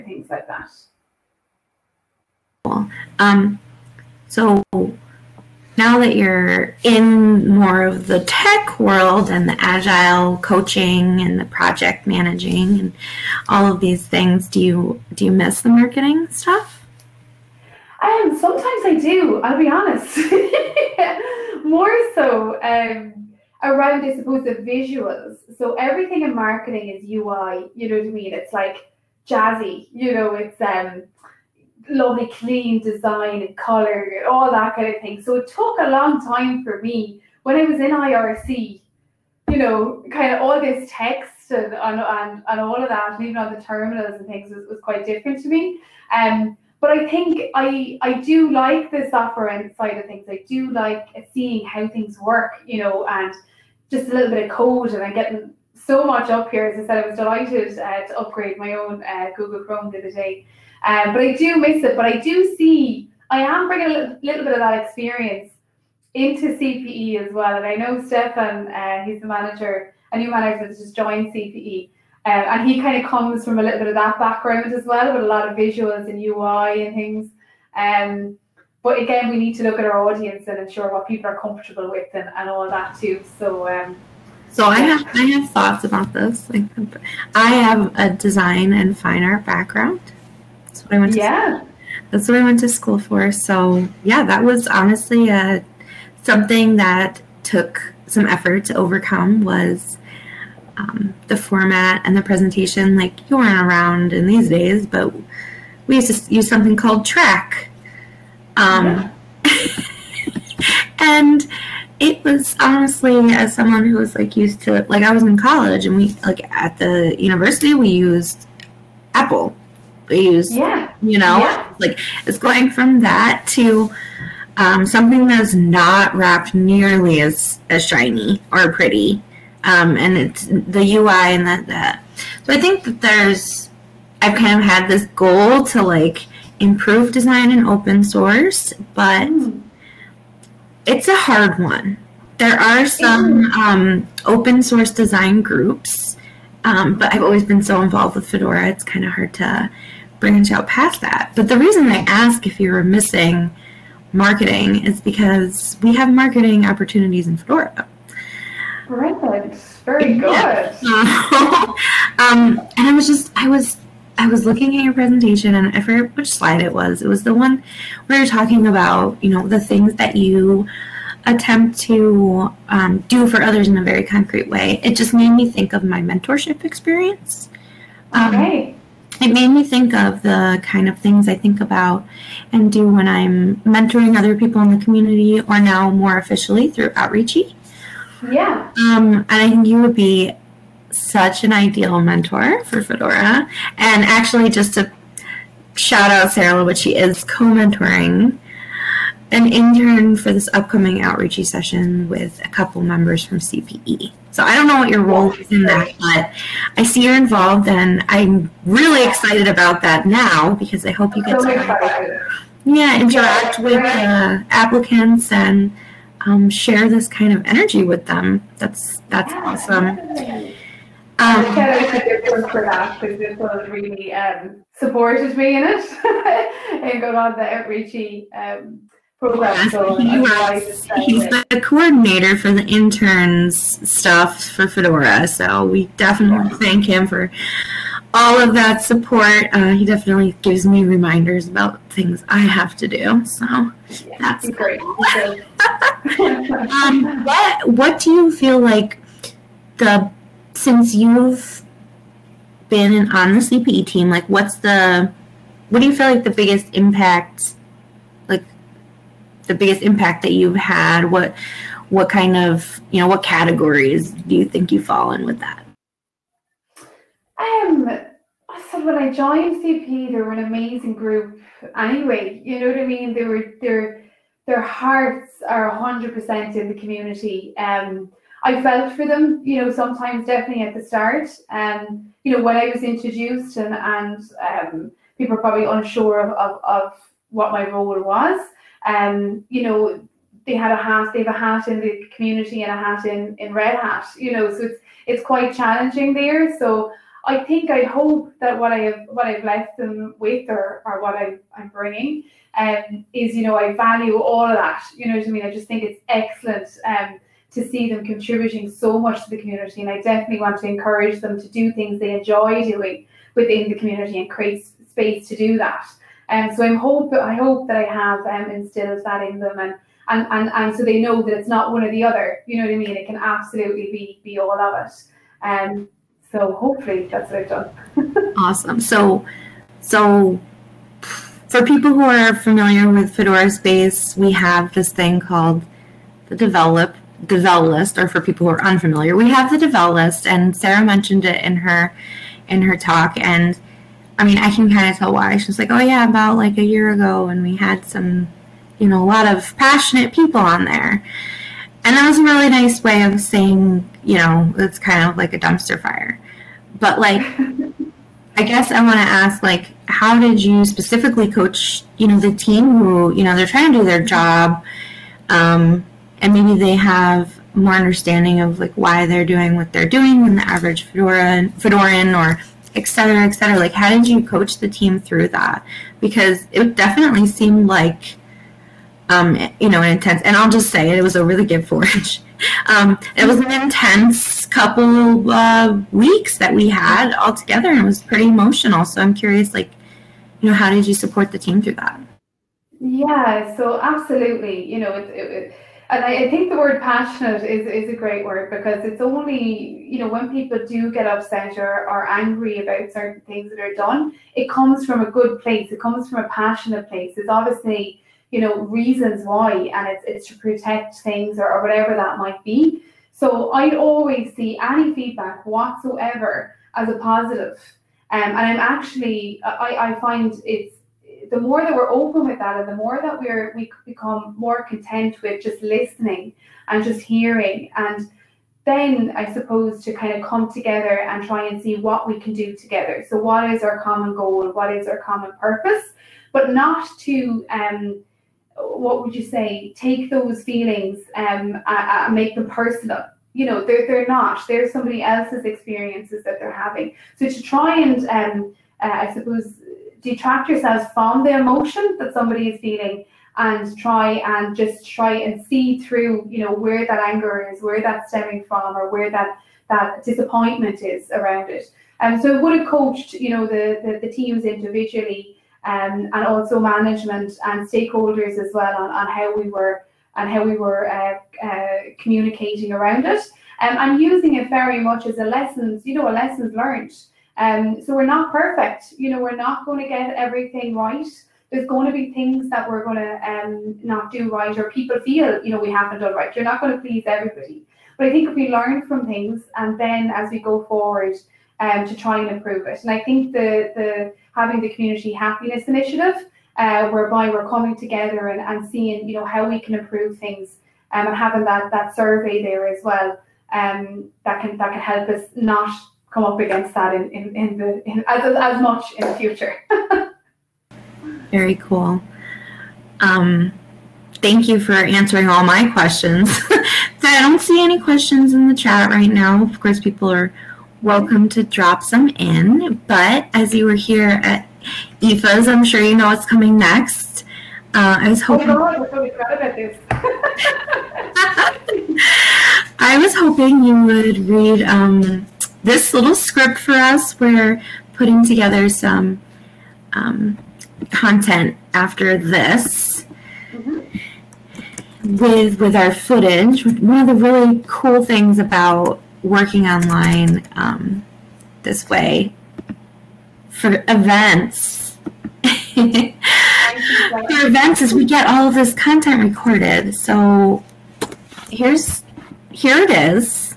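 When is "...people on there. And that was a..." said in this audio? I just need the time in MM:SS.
05:50.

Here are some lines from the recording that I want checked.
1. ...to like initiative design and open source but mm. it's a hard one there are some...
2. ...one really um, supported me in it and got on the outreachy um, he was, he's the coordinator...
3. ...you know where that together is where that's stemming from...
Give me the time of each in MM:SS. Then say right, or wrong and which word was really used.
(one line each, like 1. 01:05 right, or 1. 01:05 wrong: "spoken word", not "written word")
1. 02:15 wrong: "improve", not "initiative"
2. 03:43 right
3. 07:36 wrong: "anger", not "together".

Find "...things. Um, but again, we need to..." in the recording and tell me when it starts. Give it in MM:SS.
01:16.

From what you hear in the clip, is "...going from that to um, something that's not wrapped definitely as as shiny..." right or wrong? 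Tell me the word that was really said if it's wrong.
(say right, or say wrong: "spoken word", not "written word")
wrong: "nearly", not "definitely".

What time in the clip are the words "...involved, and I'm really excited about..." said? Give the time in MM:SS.
03:27.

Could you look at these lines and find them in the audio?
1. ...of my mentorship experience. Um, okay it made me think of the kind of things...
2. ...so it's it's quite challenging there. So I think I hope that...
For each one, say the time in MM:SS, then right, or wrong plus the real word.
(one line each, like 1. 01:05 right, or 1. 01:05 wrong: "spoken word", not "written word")
1. 02:55 right
2. 04:54 right.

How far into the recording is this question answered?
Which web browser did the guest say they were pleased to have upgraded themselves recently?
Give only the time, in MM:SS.
00:59.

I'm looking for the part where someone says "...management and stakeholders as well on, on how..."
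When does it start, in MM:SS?
07:46.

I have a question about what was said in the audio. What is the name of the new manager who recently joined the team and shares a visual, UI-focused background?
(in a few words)
Stefan.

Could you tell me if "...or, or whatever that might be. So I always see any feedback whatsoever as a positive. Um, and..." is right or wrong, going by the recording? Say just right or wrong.
right.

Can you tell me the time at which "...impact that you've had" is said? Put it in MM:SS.
04:19.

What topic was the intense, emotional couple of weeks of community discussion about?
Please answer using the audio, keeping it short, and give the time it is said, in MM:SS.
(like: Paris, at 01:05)
Git Forge, at 06:21.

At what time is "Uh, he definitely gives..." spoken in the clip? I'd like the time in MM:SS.
03:59.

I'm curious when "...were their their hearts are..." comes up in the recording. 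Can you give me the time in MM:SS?
04:33.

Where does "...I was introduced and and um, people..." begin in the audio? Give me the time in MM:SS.
04:42.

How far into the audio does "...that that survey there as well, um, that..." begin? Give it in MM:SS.
08:21.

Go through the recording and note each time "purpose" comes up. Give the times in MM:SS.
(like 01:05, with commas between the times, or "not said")
07:15.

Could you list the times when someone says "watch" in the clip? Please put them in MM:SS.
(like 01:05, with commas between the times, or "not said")
not said.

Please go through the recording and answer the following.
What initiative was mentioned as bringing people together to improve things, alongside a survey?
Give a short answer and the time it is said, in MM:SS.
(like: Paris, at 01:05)
community happiness initiative, at 08:14.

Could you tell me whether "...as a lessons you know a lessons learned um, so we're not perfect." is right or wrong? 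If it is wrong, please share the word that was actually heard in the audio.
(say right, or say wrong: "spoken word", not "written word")
right.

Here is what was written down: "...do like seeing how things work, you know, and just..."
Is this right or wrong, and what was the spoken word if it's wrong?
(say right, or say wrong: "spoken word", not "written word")
right.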